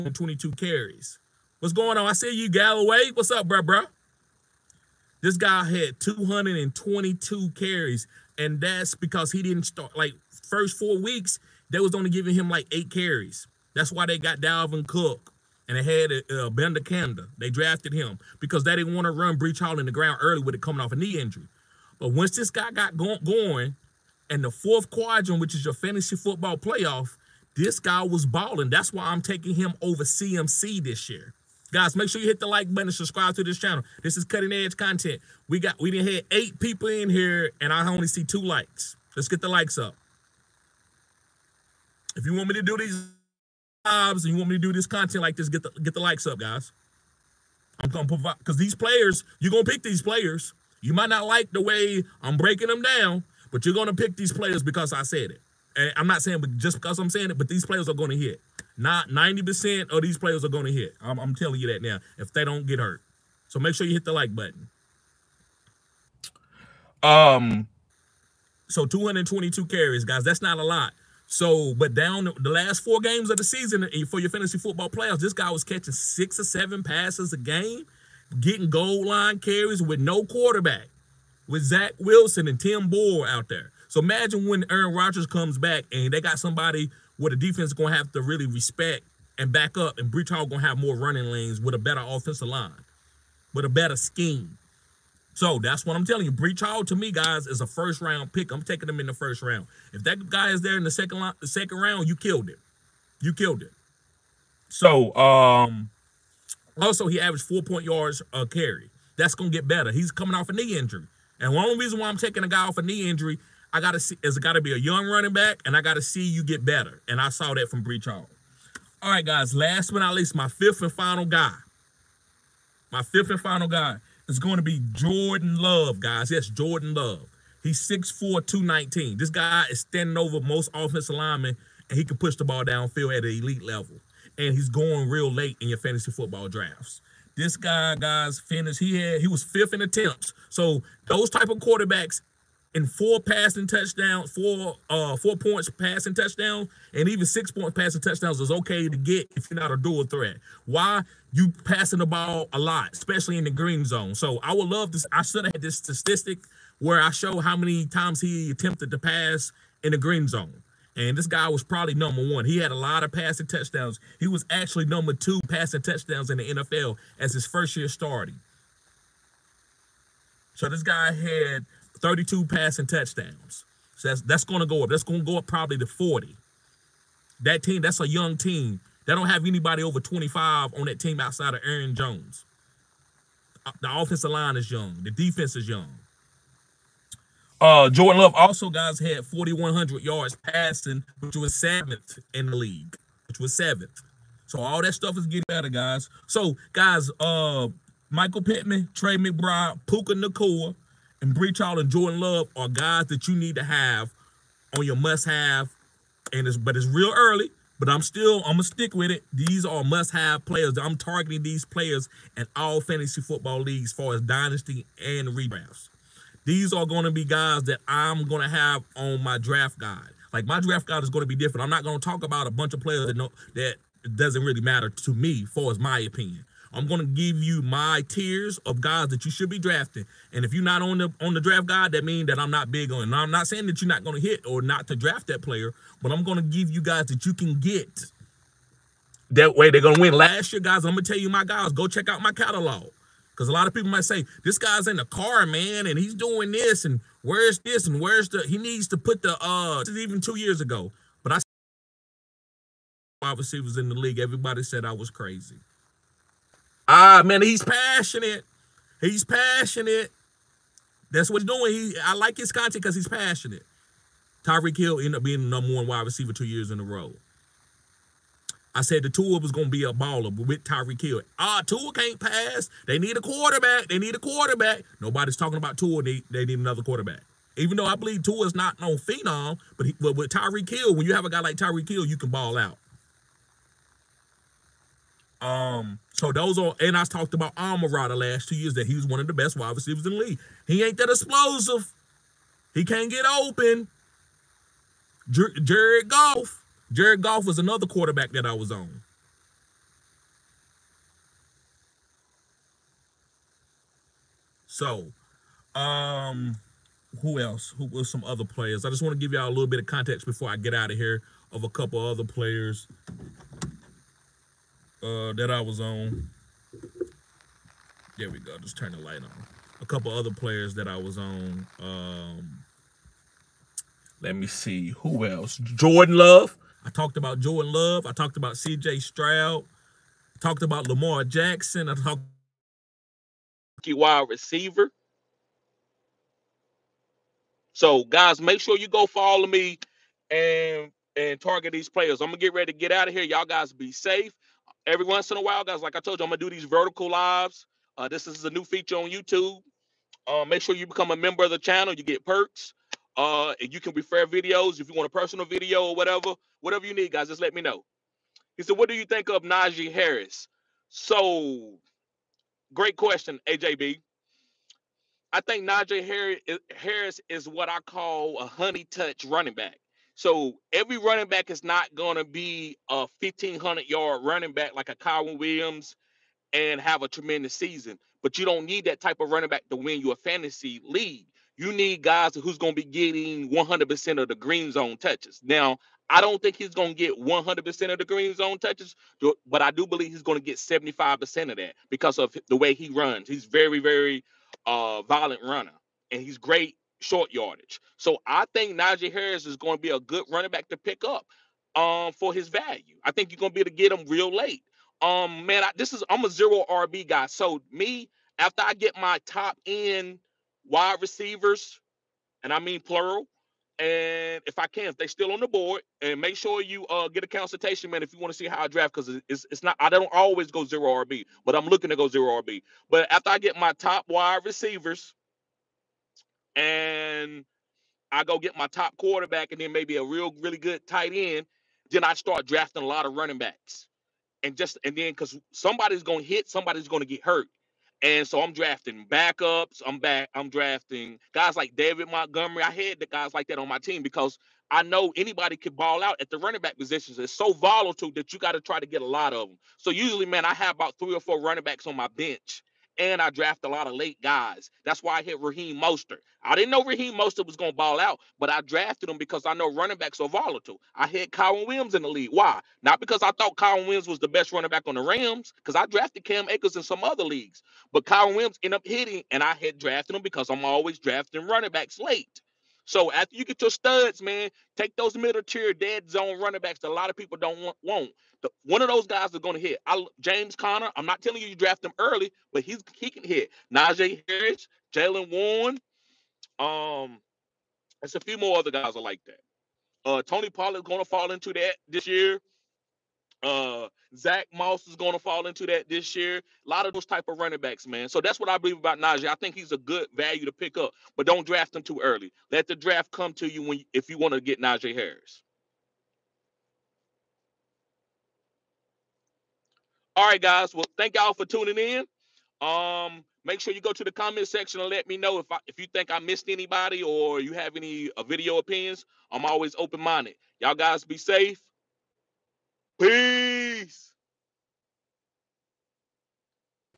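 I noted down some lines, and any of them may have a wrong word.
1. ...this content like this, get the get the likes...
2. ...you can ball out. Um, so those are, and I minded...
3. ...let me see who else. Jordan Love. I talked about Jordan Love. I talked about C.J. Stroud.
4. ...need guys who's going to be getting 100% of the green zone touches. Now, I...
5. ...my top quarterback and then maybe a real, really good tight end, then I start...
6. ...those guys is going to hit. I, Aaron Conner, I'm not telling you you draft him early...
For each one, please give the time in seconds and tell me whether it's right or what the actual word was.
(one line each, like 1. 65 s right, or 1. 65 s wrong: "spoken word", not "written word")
1. 44 s right
2. 282 s wrong: "talked", not "minded"
3. 324 s right
4. 381 s right
5. 428 s right
6. 478 s wrong: "James", not "Aaron".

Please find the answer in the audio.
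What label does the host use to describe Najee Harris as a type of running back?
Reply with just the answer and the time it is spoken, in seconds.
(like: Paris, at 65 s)
honey touch running back, at 368 s.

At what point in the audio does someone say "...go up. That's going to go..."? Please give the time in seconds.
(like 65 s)
174 s.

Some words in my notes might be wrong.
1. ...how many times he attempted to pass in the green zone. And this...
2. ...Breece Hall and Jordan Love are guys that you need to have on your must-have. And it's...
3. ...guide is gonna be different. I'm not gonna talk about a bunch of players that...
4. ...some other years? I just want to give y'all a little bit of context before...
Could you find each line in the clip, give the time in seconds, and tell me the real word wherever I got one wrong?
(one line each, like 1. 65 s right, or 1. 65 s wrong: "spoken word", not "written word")
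1. 157 s right
2. 201 s right
3. 220 s right
4. 308 s wrong: "players", not "years".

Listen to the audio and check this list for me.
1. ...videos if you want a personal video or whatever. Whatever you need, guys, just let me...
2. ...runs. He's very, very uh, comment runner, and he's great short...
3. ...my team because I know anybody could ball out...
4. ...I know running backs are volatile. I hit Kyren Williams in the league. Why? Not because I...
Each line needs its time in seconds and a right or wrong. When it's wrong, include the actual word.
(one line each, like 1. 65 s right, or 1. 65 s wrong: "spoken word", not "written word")
1. 354 s right
2. 392 s wrong: "violent", not "comment"
3. 443 s right
4. 459 s right.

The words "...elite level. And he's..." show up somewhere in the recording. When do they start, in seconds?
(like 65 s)
133 s.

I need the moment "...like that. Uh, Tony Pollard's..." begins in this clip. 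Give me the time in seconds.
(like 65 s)
489 s.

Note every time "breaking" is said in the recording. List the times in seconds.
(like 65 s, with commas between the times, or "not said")
52 s.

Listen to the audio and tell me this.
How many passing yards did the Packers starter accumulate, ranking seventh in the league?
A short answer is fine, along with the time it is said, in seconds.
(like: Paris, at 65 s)
4,100, at 189 s.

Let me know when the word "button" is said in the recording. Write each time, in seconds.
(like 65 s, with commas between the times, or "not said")
32 s, 64 s.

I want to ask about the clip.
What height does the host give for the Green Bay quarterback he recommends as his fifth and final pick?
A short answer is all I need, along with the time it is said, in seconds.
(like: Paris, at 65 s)
6'4, at 127 s.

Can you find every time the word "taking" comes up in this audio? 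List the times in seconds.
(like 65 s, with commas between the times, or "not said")
29 s, 98 s, 112 s.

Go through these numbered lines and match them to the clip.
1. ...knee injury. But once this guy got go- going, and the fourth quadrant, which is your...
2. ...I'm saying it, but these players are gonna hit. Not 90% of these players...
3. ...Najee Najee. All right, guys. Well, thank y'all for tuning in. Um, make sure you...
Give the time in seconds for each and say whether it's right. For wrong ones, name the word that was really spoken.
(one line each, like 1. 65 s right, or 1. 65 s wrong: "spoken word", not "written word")
1. 20 s right
2. 56 s right
3. 504 s wrong: "Harris", not "Najee".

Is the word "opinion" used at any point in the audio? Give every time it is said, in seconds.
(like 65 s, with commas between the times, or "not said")
225 s, 518 s.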